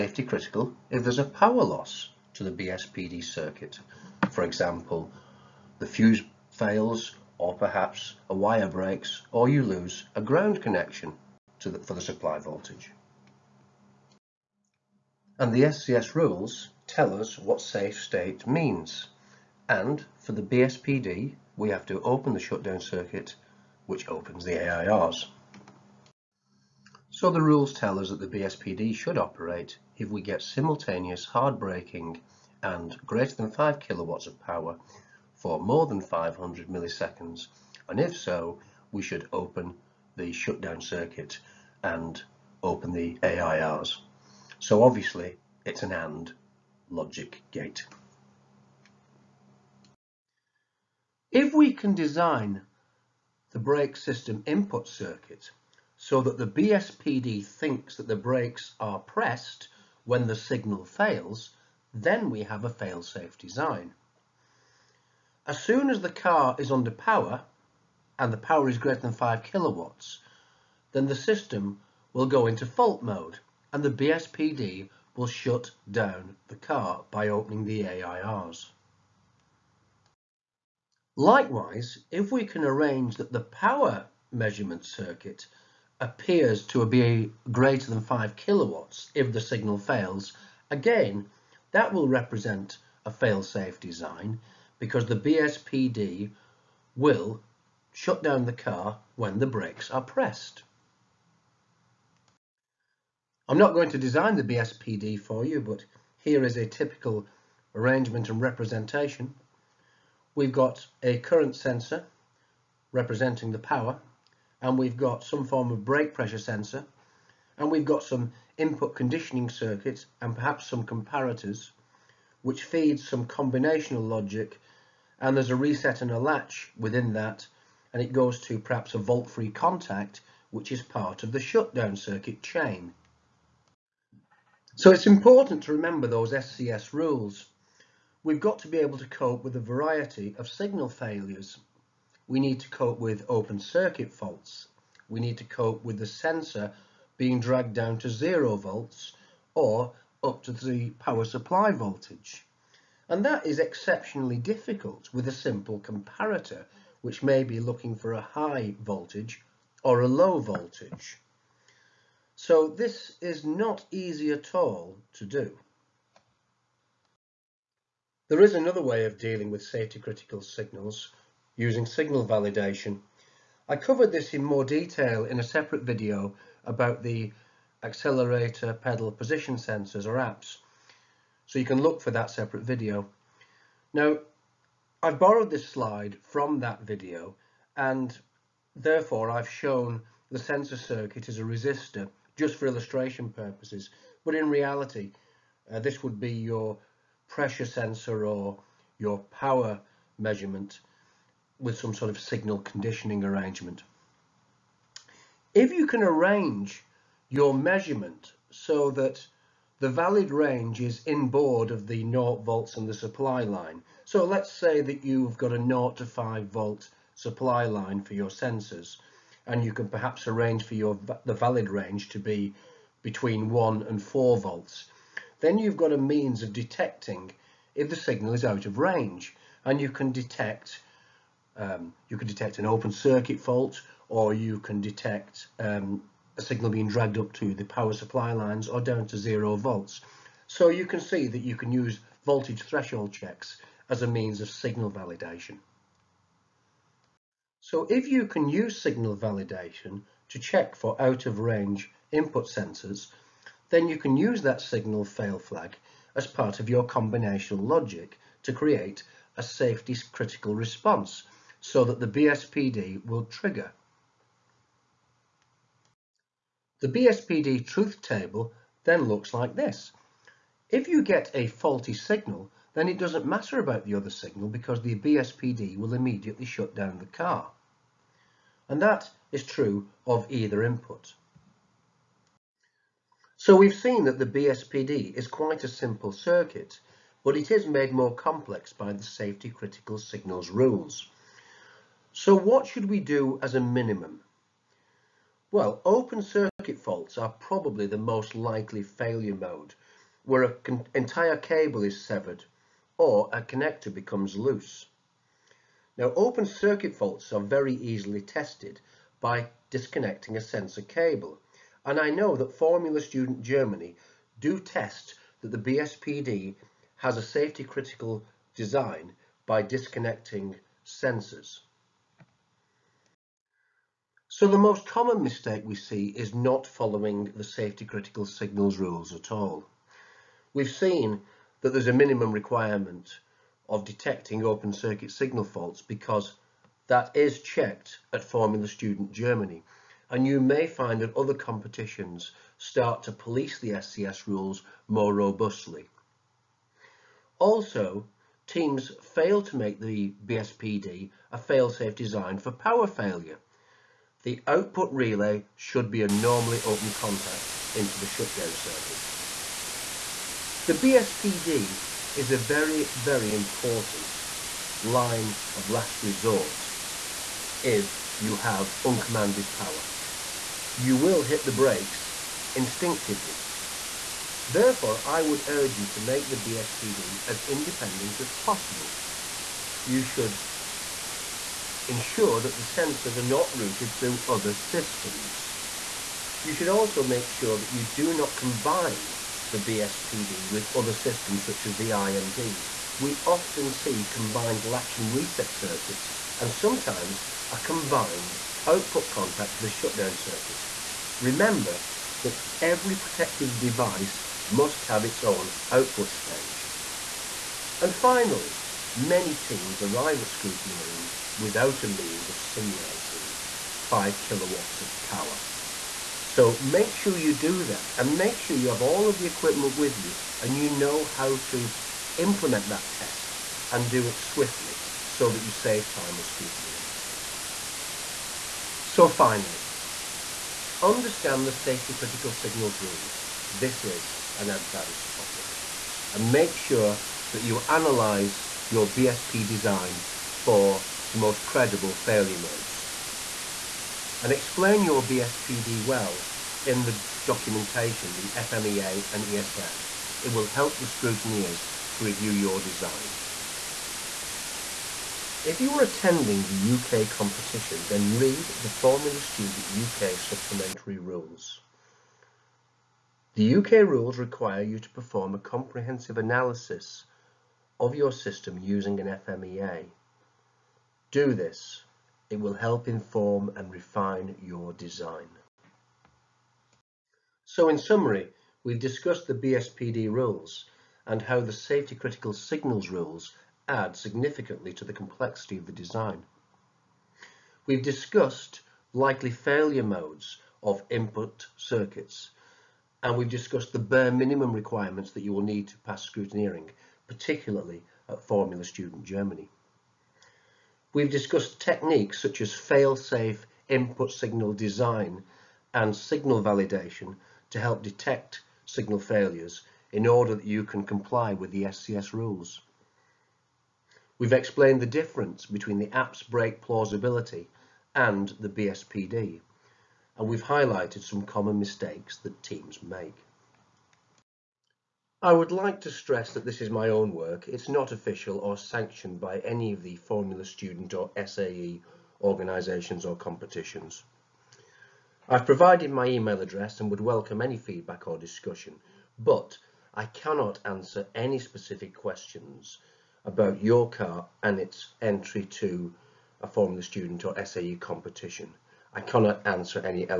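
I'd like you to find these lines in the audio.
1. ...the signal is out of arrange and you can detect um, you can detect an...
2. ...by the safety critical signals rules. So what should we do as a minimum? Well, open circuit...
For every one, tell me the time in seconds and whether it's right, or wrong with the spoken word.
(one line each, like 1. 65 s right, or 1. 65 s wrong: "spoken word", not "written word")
1. 227 s wrong: "range", not "arrange"
2. 288 s right.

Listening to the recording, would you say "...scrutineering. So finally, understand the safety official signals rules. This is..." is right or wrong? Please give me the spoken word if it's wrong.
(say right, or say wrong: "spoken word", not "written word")
wrong: "critical", not "official".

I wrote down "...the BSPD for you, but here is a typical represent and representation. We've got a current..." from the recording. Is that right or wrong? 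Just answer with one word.
wrong.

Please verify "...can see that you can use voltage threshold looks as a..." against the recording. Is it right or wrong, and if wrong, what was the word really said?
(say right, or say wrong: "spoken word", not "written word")
wrong: "checks", not "looks".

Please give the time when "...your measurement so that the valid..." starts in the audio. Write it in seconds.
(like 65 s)
207 s.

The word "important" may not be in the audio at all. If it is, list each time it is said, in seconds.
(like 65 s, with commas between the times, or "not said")
135 s, 363 s.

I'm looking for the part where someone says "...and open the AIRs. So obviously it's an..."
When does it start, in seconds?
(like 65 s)
41 s.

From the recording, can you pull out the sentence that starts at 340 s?
And you may find that other competitions start to police the SCS rules more robustly.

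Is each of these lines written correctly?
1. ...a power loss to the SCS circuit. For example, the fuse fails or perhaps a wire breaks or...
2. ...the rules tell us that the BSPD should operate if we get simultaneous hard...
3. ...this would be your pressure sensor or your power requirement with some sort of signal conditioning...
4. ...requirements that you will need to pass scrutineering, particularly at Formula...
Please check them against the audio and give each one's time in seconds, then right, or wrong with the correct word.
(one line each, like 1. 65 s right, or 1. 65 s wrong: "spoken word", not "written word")
1. 1 s wrong: "BSPD", not "SCS"
2. 27 s right
3. 195 s wrong: "measurement", not "requirement"
4. 494 s right.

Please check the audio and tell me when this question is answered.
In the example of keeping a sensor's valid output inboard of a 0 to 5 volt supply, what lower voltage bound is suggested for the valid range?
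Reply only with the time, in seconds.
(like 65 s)
223 s.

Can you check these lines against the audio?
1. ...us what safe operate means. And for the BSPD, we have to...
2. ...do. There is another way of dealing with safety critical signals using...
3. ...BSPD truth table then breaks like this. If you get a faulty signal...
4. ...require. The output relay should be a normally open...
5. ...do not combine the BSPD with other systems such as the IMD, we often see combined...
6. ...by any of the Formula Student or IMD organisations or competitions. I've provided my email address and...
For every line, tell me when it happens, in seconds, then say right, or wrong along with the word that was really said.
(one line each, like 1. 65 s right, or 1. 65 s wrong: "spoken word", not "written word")
1. 17 s wrong: "state", not "operate"
2. 165 s right
3. 266 s wrong: "looks", not "breaks"
4. 352 s wrong: "failure", not "require"
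5. 387 s right
6. 529 s wrong: "SAE", not "IMD".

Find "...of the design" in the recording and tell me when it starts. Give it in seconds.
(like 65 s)
485 s.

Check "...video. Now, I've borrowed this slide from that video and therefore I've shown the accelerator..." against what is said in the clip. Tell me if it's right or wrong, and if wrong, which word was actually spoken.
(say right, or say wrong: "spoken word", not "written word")
wrong: "sensor", not "accelerator".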